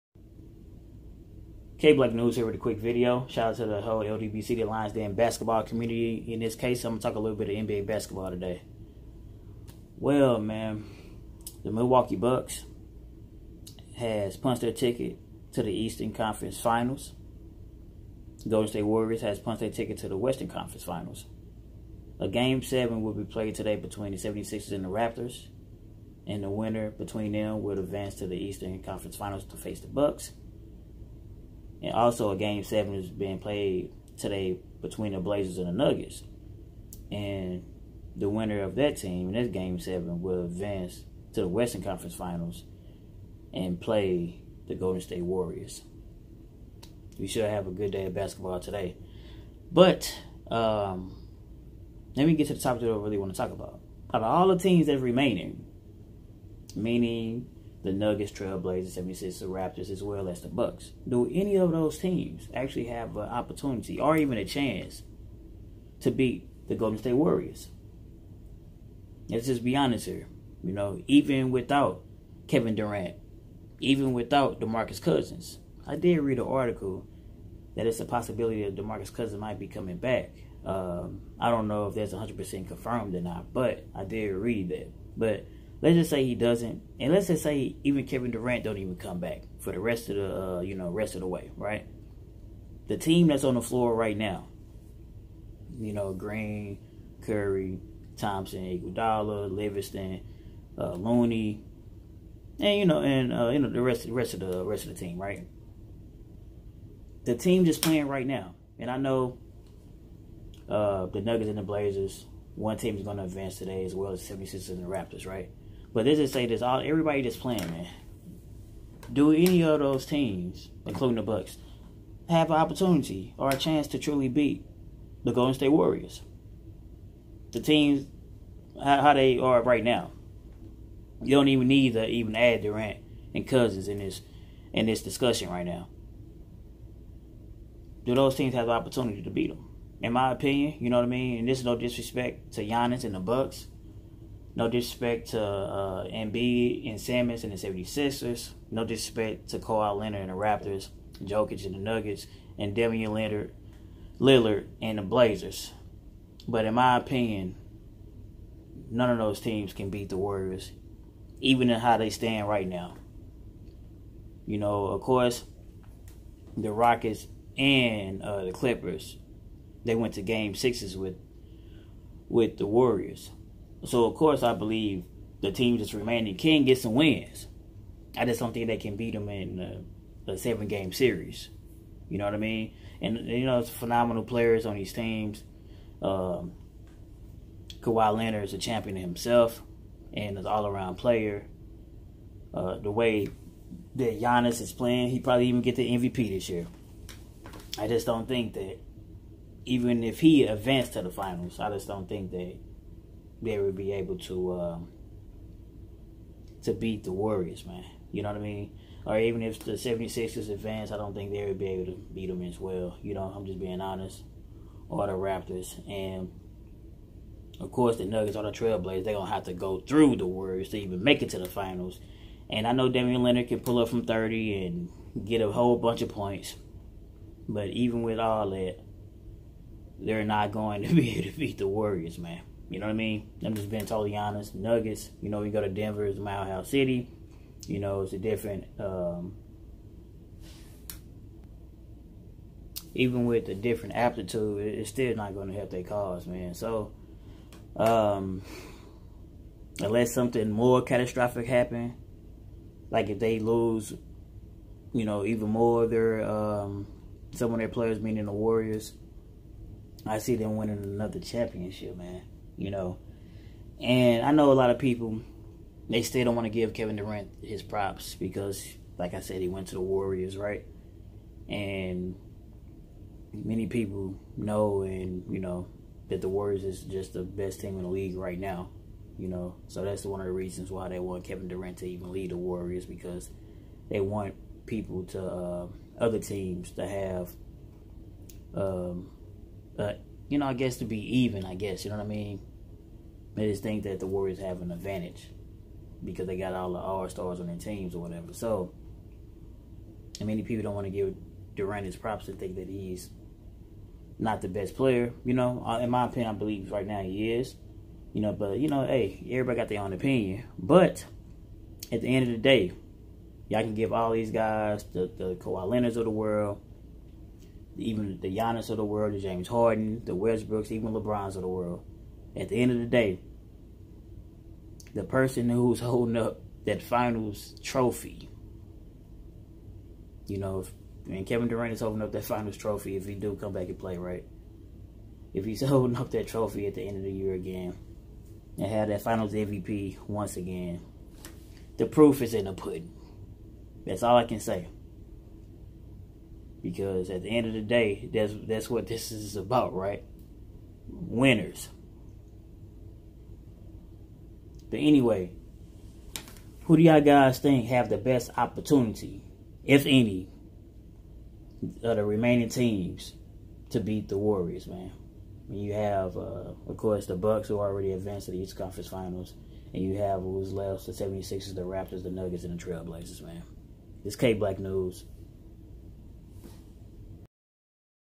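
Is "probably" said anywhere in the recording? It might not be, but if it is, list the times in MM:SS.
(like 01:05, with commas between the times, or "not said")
03:15.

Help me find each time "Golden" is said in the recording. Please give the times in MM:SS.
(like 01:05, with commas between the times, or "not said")
00:18, 00:44, 01:06, 02:05.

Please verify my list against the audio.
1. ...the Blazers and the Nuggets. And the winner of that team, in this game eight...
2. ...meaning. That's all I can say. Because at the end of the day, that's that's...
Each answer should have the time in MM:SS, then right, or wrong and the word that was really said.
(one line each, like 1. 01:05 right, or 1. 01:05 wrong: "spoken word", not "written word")
1. 00:35 wrong: "seven", not "eight"
2. 05:42 wrong: "pudding", not "meaning".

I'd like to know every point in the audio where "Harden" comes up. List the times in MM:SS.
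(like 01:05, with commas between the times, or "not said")
05:19.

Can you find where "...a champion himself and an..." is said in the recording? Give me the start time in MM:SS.
03:08.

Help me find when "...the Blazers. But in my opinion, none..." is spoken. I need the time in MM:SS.
02:34.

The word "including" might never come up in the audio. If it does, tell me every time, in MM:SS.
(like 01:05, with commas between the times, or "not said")
02:00.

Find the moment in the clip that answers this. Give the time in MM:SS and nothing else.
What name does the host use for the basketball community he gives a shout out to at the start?
00:04.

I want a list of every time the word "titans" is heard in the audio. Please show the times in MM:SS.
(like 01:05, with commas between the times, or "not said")
not said.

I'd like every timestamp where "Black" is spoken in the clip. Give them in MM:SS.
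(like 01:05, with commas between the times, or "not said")
00:01, 06:14.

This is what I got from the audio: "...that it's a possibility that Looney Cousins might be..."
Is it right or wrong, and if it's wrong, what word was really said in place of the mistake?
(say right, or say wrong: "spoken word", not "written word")
wrong: "DeMarcus", not "Looney".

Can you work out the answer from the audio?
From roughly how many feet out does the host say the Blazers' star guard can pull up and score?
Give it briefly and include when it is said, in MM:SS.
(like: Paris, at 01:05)
30, at 03:44.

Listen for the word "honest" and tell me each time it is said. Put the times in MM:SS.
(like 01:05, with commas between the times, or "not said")
01:09, 03:33, 03:54.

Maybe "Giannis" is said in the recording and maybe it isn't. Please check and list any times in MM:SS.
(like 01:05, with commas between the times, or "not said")
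02:22, 03:14, 05:18.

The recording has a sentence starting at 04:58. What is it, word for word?
So, and many people don't want to give Durant his props and think that he's not the best player.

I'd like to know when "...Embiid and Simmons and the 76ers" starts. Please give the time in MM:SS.
02:26.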